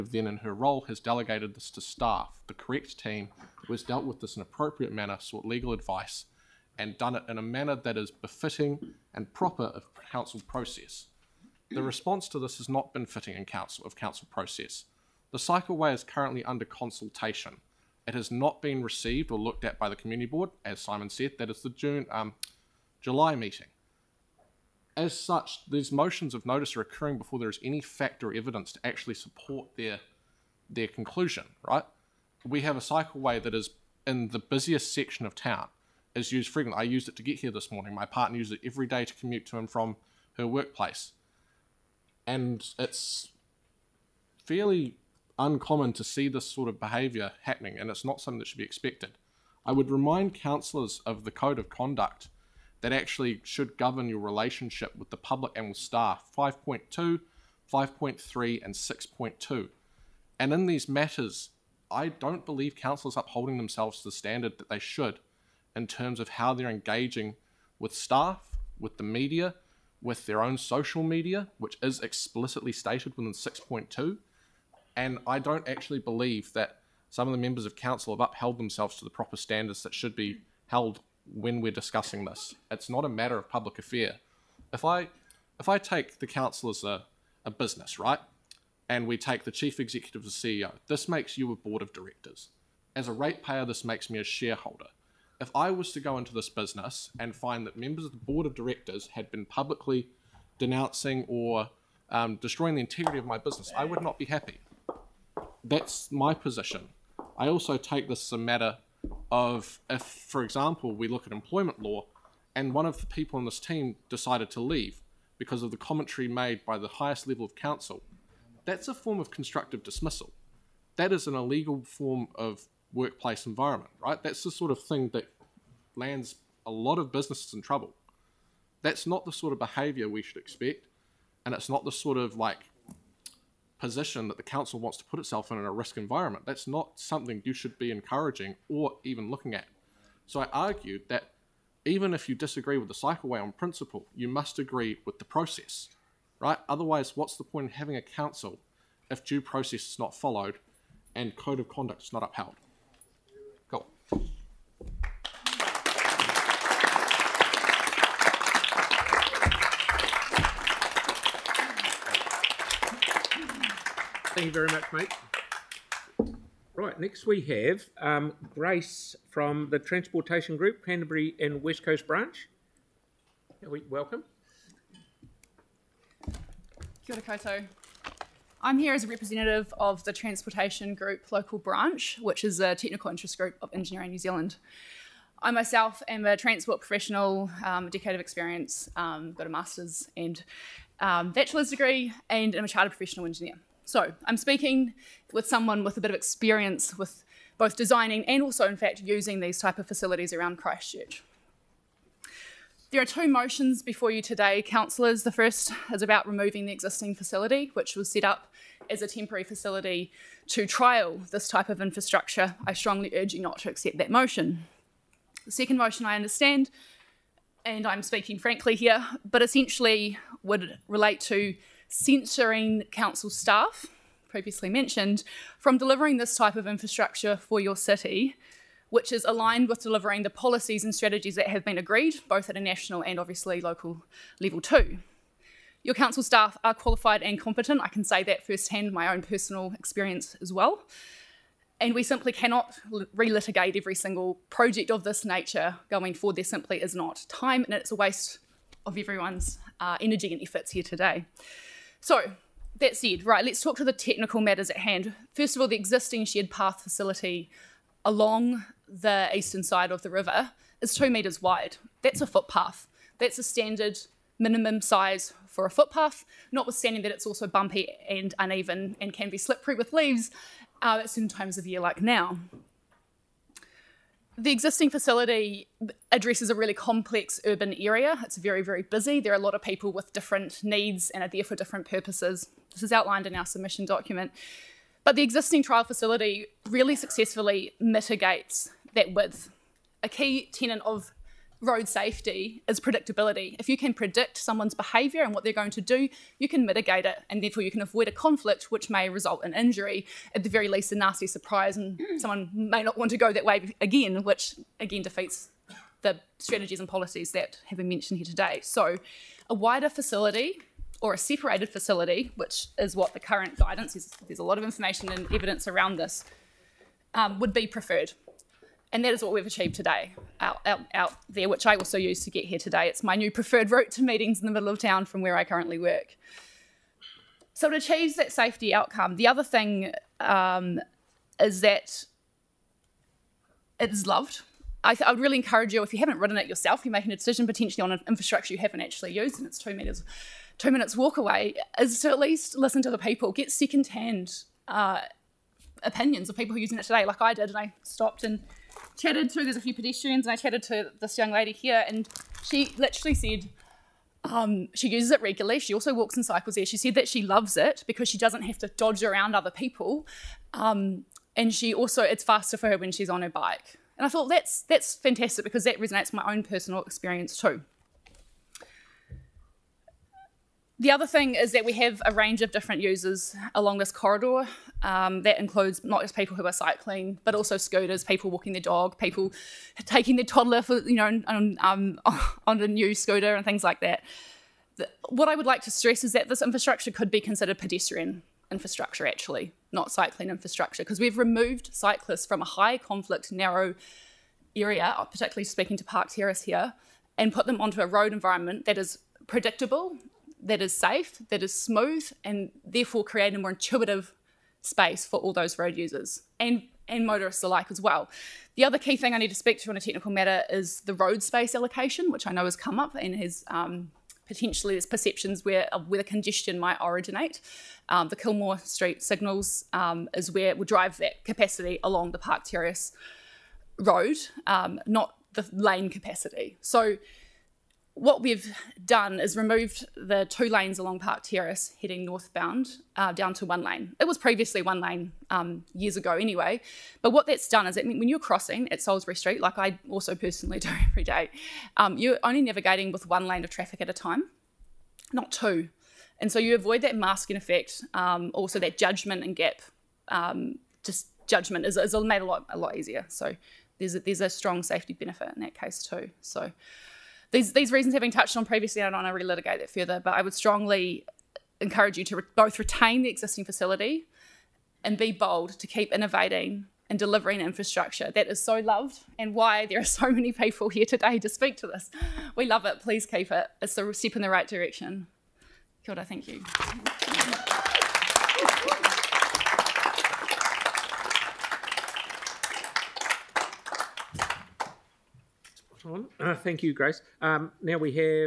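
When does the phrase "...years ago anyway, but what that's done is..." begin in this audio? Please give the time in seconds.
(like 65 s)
435 s.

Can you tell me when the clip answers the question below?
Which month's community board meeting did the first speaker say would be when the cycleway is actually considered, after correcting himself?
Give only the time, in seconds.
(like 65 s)
23 s.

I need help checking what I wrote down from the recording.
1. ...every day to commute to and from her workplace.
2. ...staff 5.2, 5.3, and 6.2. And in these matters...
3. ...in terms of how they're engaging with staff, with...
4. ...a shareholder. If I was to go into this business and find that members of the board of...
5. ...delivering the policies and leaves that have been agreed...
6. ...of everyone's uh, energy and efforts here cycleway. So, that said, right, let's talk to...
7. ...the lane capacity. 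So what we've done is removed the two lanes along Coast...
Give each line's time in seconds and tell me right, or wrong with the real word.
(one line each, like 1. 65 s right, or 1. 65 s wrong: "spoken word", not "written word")
1. 38 s right
2. 55 s right
3. 65 s right
4. 94 s right
5. 229 s wrong: "strategies", not "leaves"
6. 248 s wrong: "today", not "cycleway"
7. 425 s wrong: "Park", not "Coast".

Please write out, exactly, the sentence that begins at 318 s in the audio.
And that is what we've achieved today out, out, out there, which I also use to get here today.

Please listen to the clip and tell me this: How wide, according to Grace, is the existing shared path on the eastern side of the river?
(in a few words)
2 metres.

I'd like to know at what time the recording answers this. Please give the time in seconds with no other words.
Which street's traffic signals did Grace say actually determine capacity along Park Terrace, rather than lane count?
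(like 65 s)
418 s.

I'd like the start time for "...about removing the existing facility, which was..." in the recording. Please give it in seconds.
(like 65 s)
206 s.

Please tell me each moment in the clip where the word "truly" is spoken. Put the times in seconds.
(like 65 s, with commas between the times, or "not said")
not said.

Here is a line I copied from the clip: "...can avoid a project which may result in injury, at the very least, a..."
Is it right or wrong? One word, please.
wrong.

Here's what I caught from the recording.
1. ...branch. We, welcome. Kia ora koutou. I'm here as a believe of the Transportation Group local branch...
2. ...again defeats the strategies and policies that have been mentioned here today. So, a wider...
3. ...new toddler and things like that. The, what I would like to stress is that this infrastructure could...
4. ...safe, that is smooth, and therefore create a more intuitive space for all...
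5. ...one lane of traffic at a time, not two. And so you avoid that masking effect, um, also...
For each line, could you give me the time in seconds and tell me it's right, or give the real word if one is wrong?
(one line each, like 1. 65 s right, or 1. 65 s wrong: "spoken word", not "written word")
1. 172 s wrong: "representative", not "believe"
2. 304 s right
3. 382 s wrong: "scooter", not "toddler"
4. 400 s right
5. 443 s right.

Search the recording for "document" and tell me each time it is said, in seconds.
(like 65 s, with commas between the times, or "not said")
283 s.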